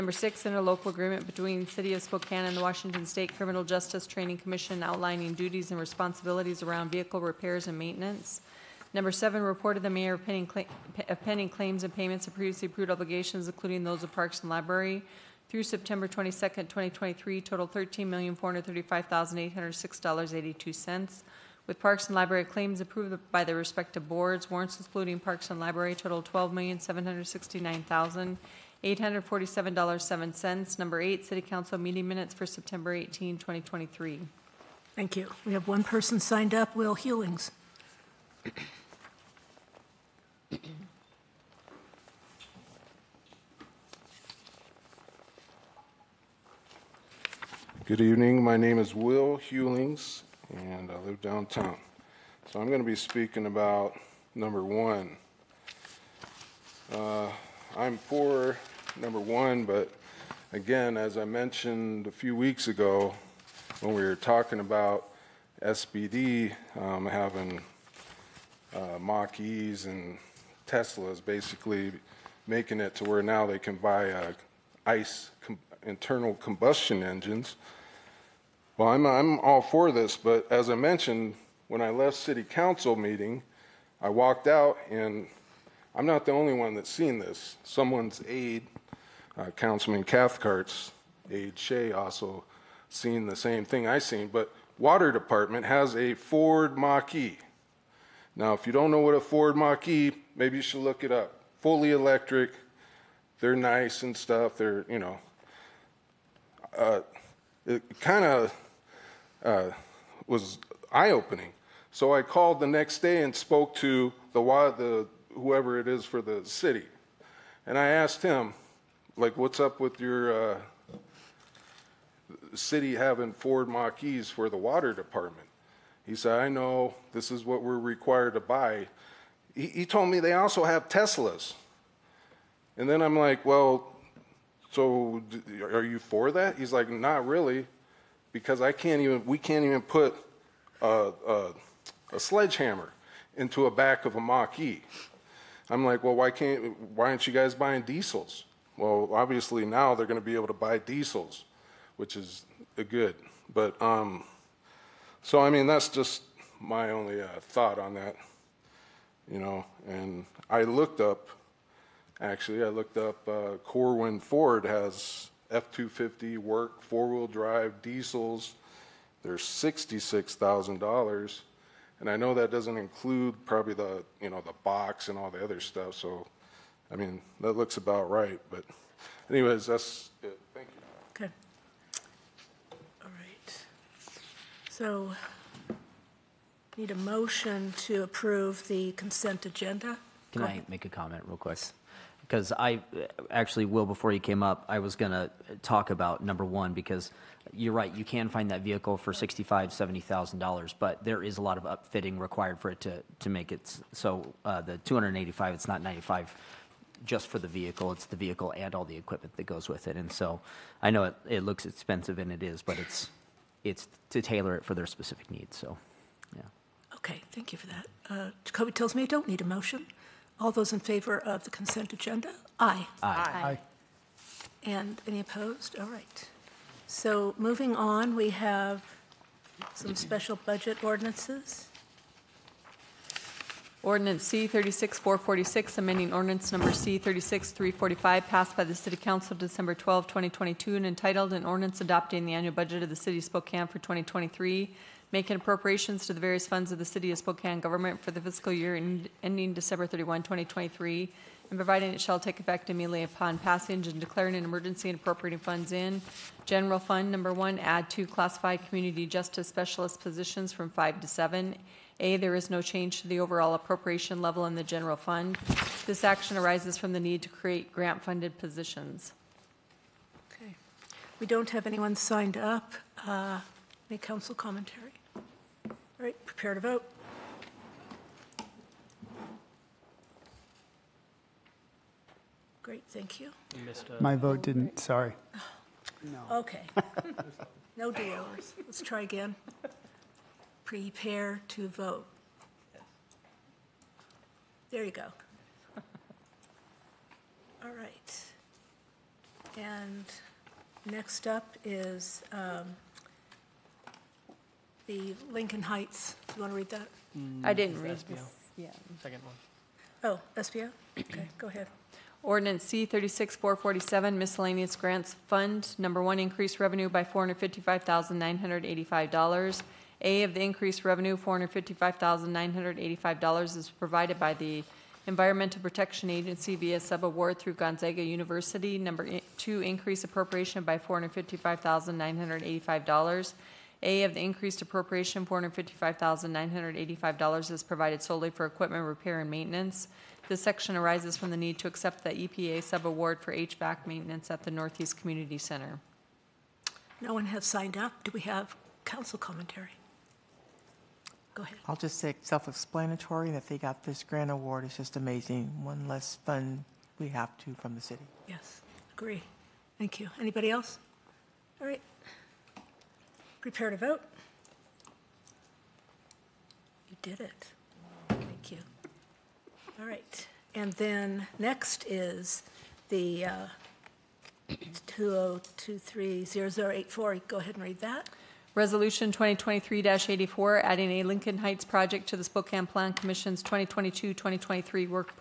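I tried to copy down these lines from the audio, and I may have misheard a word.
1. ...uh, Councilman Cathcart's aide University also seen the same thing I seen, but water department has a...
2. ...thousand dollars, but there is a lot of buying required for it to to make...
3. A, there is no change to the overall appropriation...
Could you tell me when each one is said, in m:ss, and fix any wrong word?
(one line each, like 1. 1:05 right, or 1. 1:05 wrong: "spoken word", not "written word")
1. 1:29 wrong: "Shay", not "University"
2. 3:20 wrong: "upfitting", not "buying"
3. 4:22 right.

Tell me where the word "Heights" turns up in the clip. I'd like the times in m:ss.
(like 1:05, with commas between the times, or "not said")
5:05, 6:21.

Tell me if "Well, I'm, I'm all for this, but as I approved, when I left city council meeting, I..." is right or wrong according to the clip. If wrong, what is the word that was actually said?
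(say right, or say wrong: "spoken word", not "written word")
wrong: "mentioned", not "approved".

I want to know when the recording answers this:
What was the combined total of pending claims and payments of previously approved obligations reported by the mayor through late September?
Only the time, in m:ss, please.
0:17.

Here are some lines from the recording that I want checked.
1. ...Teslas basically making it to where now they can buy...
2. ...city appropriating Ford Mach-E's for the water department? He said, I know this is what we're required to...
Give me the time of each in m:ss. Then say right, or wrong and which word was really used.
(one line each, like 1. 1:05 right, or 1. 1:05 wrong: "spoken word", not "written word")
1. 1:10 right
2. 2:02 wrong: "having", not "appropriating".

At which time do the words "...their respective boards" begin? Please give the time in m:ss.
0:23.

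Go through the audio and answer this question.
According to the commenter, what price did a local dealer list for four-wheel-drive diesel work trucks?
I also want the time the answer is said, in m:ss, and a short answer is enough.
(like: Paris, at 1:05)
$66,000, at 2:49.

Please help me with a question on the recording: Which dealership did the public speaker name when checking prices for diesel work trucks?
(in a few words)
Corwin Ford.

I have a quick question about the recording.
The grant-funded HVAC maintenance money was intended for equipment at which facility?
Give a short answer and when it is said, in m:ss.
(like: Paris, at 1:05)
Northeast Community Center, at 5:44.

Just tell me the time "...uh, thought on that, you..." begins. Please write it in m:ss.
2:37.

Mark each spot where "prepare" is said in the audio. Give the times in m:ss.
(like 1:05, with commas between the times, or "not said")
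4:36, 4:50, 6:03.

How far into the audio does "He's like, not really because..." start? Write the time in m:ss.
2:16.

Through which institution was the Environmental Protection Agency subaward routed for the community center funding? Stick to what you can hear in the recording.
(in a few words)
Gonzaga University.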